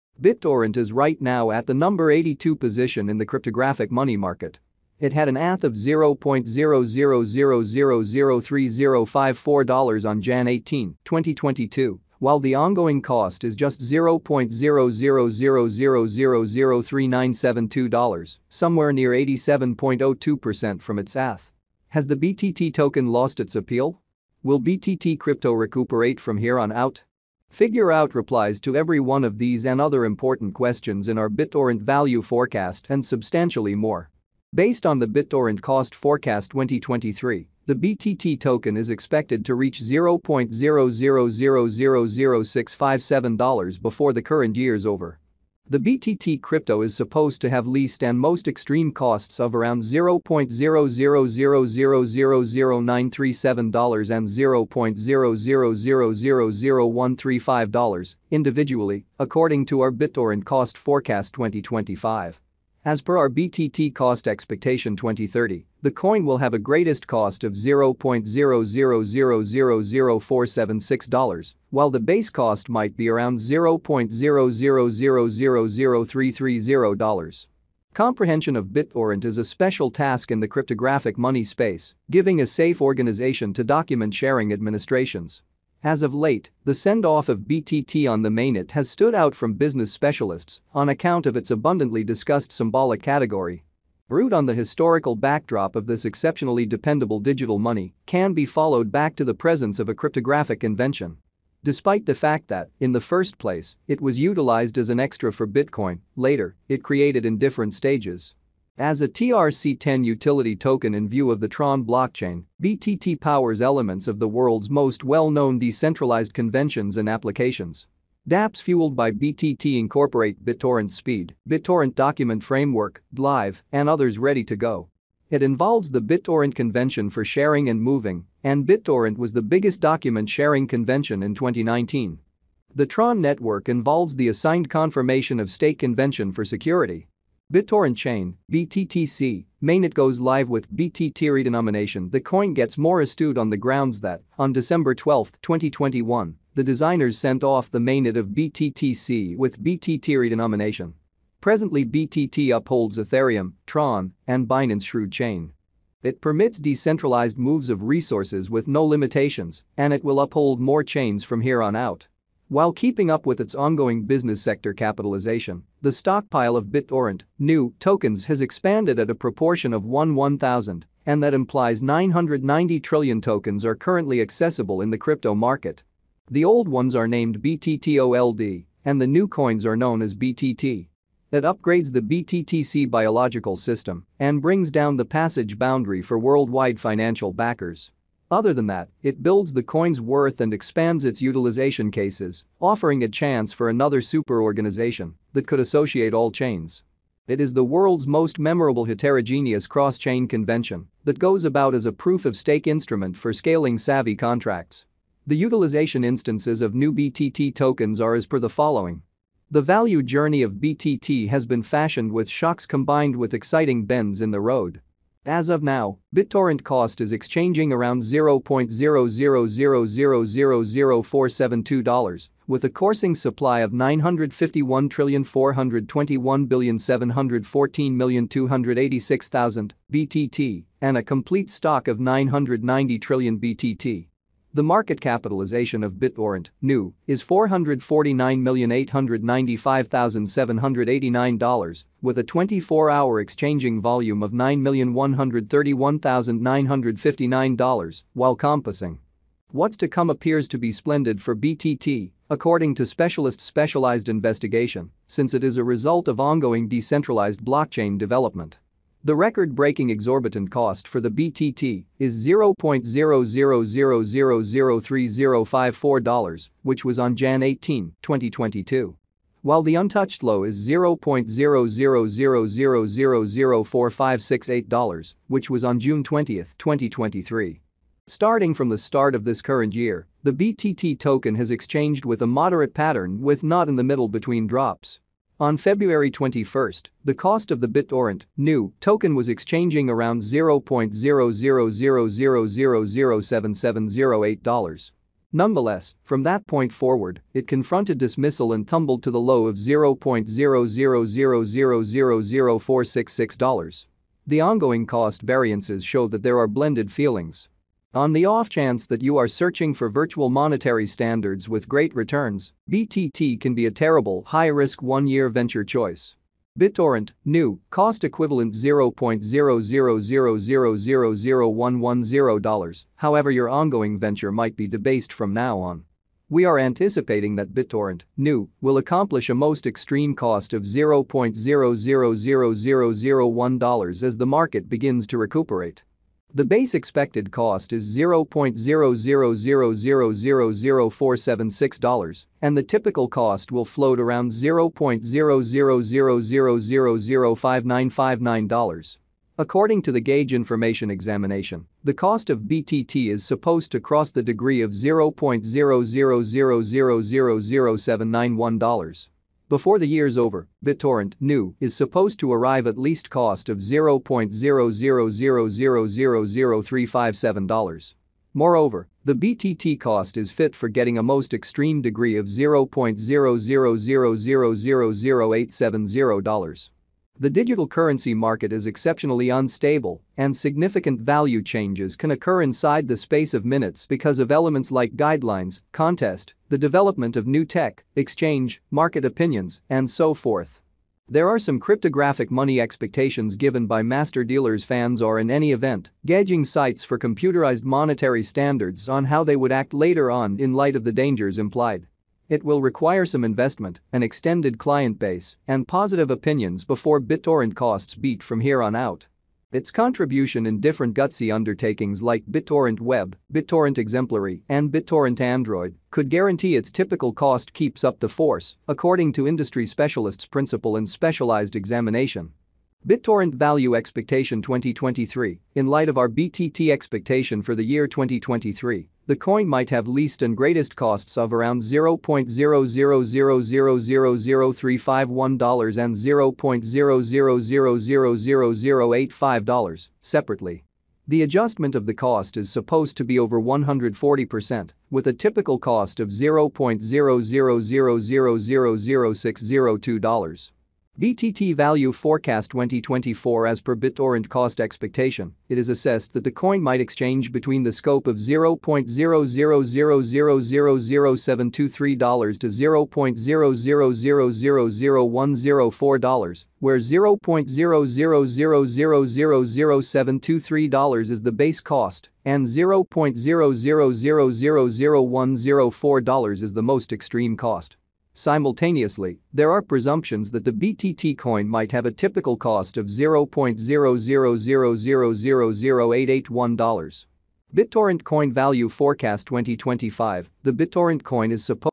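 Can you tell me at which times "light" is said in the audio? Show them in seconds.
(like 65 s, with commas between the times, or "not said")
400 s, 425 s.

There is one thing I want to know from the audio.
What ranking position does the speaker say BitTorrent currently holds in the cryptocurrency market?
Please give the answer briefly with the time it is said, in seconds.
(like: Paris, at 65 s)
82, at 1 s.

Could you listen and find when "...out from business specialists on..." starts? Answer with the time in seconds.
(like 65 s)
89 s.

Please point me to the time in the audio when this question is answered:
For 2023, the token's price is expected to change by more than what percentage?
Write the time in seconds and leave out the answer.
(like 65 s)
443 s.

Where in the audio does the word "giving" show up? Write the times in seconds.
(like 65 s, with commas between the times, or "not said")
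82 s.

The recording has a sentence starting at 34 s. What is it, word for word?
Based on the BitTorrent cost forecast 2023, the BTT token is expected to reach $0.000000657 before the current year's over.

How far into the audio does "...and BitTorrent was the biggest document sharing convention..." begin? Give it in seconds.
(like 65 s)
128 s.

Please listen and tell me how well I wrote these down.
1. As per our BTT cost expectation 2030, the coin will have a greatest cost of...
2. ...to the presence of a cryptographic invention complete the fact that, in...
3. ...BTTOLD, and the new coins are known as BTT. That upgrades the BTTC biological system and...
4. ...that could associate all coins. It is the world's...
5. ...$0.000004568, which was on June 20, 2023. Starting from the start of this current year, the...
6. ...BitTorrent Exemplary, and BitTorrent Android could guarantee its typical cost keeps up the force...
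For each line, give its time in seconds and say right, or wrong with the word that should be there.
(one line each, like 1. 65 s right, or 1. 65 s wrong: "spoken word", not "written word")
1. 62 s right
2. 99 s wrong: "despite", not "complete"
3. 177 s right
4. 195 s wrong: "chains", not "coins"
5. 270 s right
6. 413 s right.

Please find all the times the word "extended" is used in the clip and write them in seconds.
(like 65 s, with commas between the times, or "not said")
404 s.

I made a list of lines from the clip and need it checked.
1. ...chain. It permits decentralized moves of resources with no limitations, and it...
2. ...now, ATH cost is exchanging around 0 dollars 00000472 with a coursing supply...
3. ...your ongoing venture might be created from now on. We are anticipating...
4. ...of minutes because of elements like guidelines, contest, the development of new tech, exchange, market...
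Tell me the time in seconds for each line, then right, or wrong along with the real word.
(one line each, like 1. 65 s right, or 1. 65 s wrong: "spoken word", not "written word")
1. 155 s right
2. 215 s wrong: "BitTorrent", not "ATH"
3. 323 s wrong: "debased", not "created"
4. 383 s right.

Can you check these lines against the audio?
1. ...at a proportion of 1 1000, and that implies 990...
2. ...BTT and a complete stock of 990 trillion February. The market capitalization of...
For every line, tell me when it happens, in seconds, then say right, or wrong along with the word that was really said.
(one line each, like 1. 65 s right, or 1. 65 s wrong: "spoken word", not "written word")
1. 168 s right
2. 229 s wrong: "BTT", not "February".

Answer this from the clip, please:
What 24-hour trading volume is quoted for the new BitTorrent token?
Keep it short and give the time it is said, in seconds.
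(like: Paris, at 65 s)
$9,131,959, at 244 s.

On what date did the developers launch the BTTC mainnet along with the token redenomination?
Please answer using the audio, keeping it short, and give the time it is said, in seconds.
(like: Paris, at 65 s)
December 12, 2021, at 144 s.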